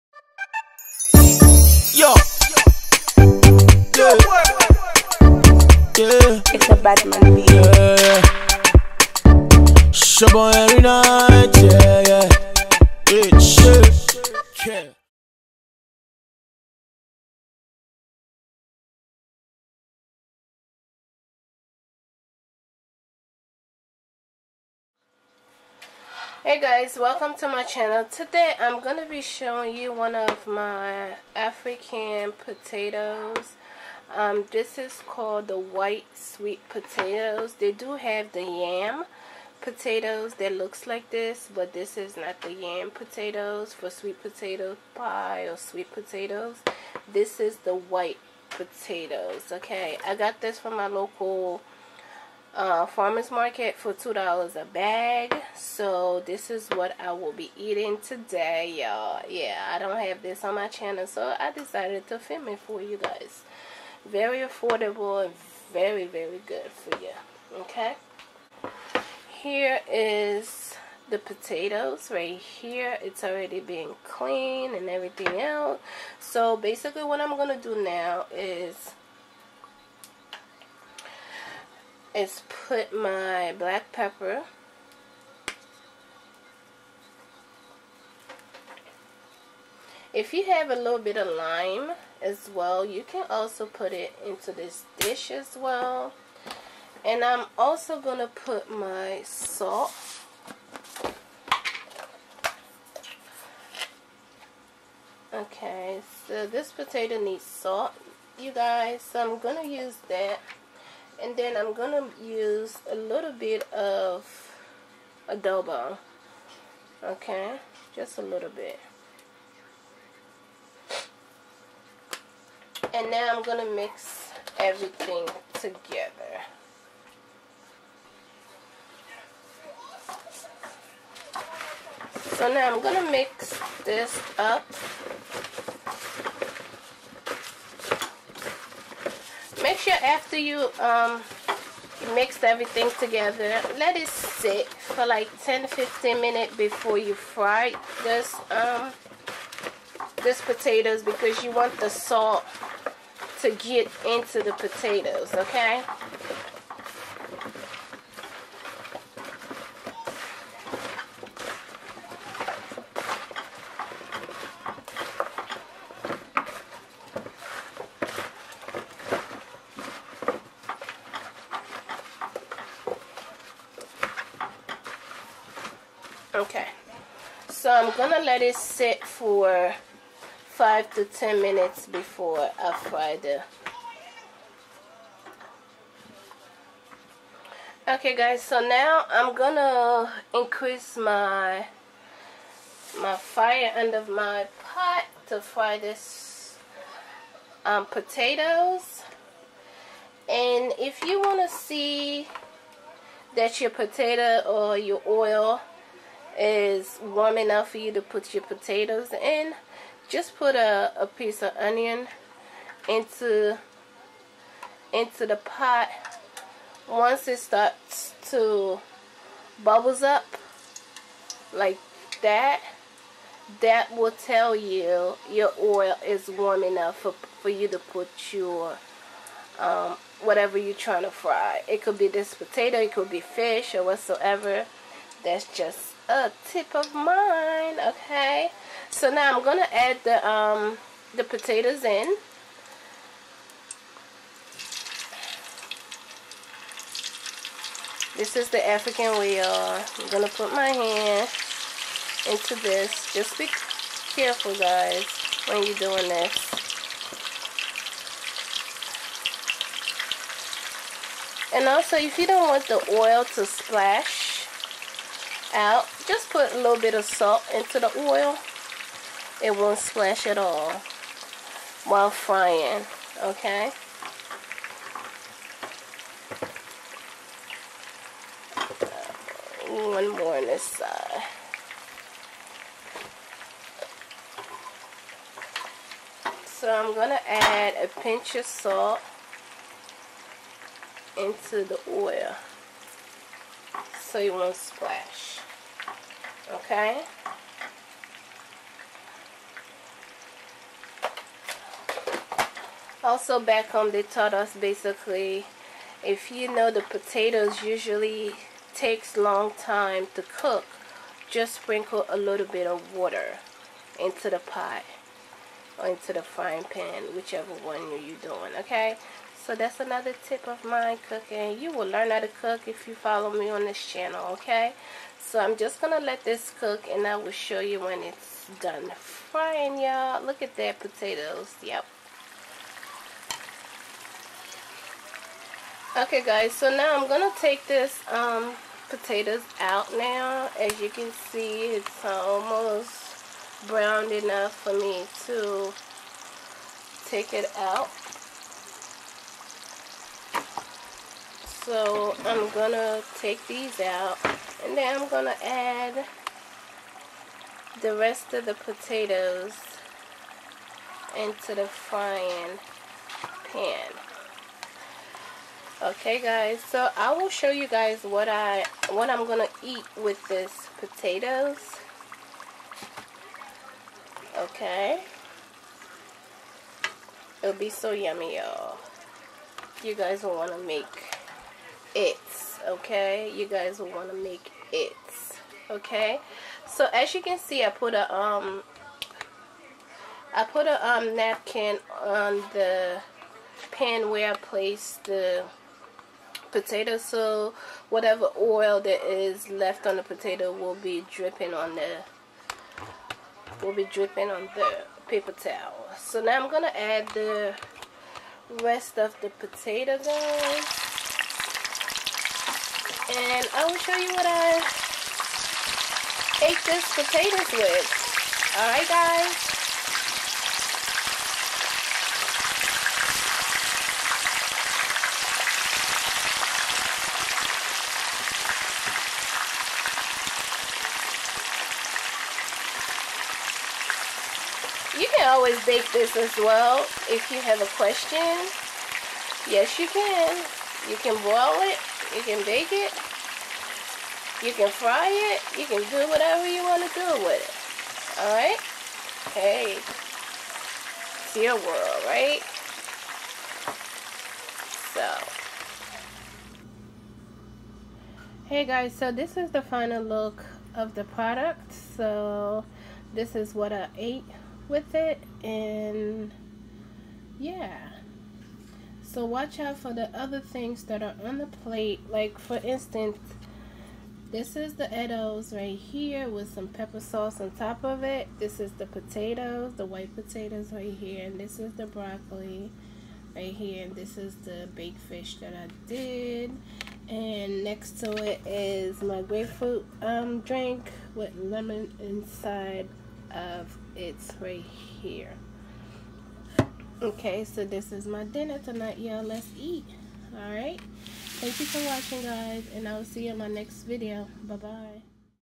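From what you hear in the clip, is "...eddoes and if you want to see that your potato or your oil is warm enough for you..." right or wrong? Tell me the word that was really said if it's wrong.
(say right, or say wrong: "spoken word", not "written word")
wrong: "potatoes", not "eddoes".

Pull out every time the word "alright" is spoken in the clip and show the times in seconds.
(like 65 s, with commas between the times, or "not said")
418 s, 448 s.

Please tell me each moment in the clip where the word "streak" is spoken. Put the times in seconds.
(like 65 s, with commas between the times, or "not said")
not said.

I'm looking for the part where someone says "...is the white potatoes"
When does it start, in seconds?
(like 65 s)
47 s.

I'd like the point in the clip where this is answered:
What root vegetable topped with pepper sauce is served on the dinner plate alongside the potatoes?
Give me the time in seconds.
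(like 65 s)
474 s.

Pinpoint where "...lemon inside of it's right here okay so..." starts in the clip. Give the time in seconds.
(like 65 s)
491 s.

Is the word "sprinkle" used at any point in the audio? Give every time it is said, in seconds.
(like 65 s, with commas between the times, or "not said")
311 s.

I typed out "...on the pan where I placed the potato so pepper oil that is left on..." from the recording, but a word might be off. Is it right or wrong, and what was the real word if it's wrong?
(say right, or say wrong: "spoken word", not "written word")
wrong: "whatever", not "pepper".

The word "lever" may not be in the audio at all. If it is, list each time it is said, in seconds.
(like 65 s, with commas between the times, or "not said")
not said.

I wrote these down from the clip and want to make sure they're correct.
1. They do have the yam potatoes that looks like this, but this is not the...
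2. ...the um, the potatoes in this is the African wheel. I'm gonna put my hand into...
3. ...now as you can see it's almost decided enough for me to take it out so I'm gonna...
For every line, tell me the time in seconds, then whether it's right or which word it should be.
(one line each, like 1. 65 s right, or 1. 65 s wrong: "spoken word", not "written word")
1. 37 s right
2. 240 s right
3. 339 s wrong: "browned", not "decided".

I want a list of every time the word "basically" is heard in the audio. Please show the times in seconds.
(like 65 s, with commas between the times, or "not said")
76 s, 304 s.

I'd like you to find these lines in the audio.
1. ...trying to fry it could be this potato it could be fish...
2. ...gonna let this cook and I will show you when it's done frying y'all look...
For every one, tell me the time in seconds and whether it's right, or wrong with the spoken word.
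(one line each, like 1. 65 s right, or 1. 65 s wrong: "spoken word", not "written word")
1. 230 s right
2. 325 s right.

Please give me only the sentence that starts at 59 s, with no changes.
Yeah, I don't have this on my channel, so I decided to film it for you guys.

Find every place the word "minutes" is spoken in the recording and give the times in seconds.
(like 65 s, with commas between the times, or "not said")
146 s, 181 s.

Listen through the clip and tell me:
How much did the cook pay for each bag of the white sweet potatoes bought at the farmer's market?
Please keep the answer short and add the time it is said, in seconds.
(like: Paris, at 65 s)
$2, at 53 s.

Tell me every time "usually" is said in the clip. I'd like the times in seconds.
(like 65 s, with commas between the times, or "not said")
307 s.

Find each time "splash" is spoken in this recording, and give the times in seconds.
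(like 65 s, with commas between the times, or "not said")
263 s, 269 s, 294 s.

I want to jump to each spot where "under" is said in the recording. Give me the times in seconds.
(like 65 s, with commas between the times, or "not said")
193 s.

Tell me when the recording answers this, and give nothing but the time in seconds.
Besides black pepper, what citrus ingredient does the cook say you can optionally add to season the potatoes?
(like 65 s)
91 s.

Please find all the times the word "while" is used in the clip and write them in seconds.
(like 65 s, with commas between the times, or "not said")
271 s.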